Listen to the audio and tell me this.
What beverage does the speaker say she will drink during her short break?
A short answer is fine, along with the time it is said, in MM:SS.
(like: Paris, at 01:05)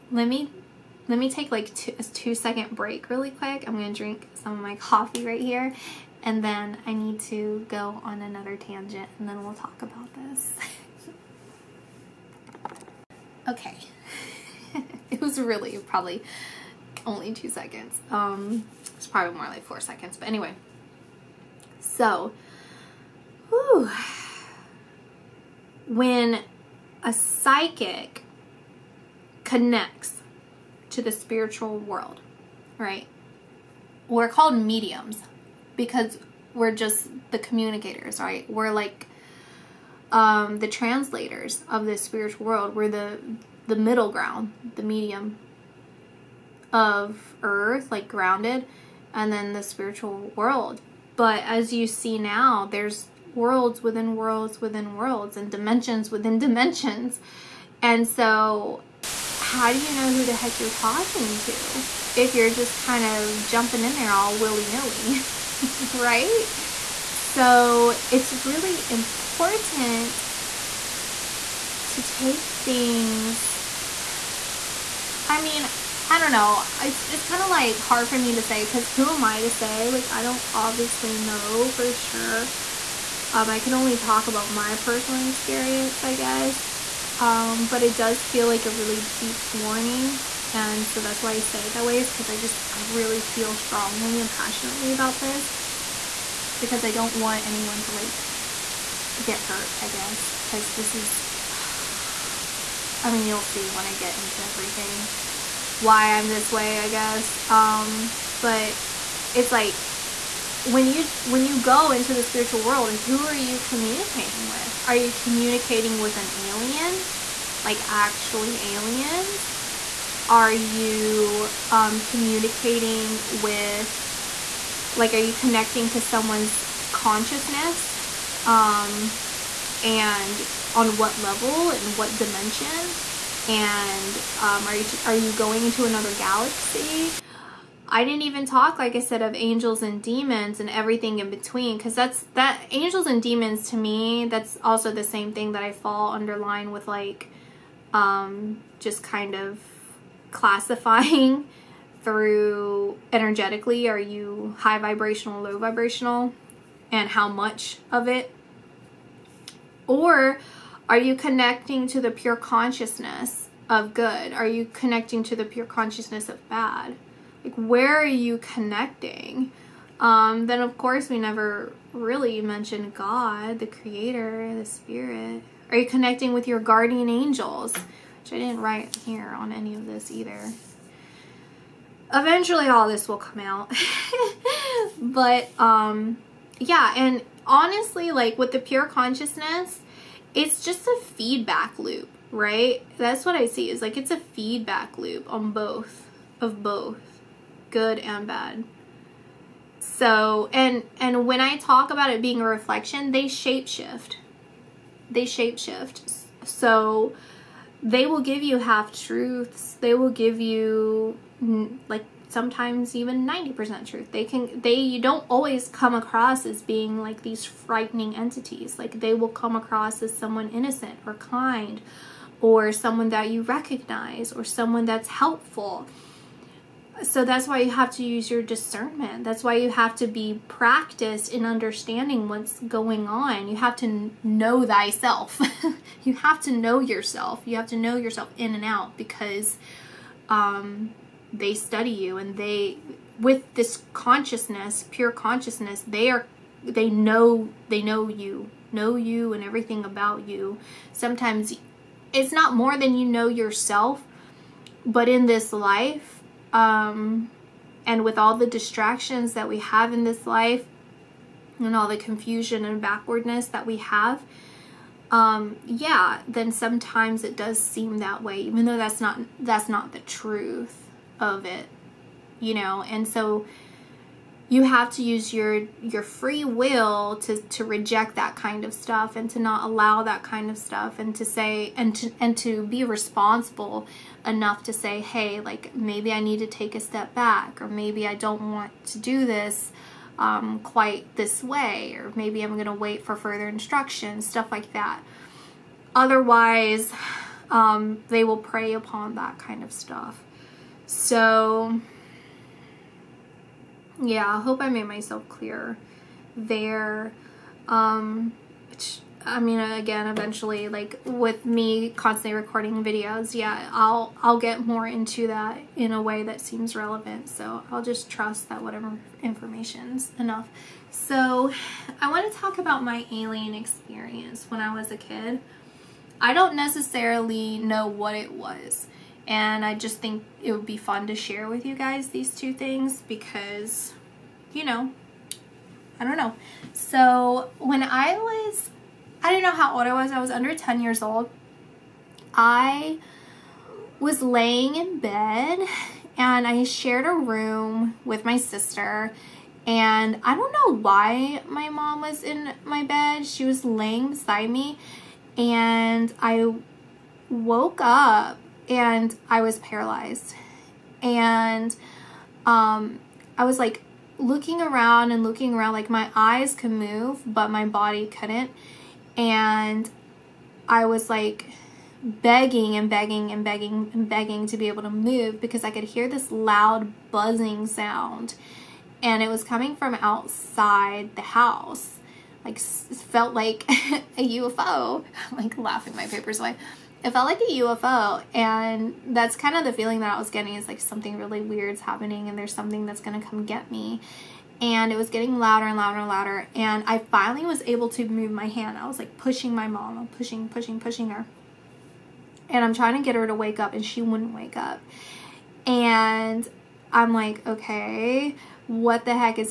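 Coffee, at 00:04.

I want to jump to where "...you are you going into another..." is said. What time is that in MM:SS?
02:14.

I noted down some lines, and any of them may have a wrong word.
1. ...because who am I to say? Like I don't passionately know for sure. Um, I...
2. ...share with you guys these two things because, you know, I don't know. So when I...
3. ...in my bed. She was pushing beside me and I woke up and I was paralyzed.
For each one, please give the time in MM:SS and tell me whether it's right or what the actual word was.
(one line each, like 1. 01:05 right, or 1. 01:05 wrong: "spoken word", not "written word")
1. 01:18 wrong: "obviously", not "passionately"
2. 05:31 right
3. 05:52 wrong: "laying", not "pushing".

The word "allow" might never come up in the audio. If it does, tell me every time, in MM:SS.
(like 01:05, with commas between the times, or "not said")
04:39.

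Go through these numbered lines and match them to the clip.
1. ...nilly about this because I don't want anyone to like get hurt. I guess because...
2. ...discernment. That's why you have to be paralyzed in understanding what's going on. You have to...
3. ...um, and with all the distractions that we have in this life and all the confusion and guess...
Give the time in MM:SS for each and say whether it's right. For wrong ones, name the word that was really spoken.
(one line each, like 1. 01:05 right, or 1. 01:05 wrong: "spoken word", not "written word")
1. 01:34 wrong: "passionately", not "nilly"
2. 03:48 wrong: "practiced", not "paralyzed"
3. 04:16 wrong: "backwardness", not "guess".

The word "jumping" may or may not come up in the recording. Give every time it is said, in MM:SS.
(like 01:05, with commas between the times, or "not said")
01:03.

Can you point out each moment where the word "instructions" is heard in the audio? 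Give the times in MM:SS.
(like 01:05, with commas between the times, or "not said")
04:53.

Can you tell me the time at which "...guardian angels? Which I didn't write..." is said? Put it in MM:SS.
02:56.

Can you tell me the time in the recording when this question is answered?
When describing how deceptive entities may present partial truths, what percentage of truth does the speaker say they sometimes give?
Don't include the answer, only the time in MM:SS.
03:33.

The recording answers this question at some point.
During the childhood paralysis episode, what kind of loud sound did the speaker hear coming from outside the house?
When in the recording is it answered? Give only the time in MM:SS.
06:17.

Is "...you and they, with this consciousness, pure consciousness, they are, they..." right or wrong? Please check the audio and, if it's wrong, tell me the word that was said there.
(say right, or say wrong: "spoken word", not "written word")
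right.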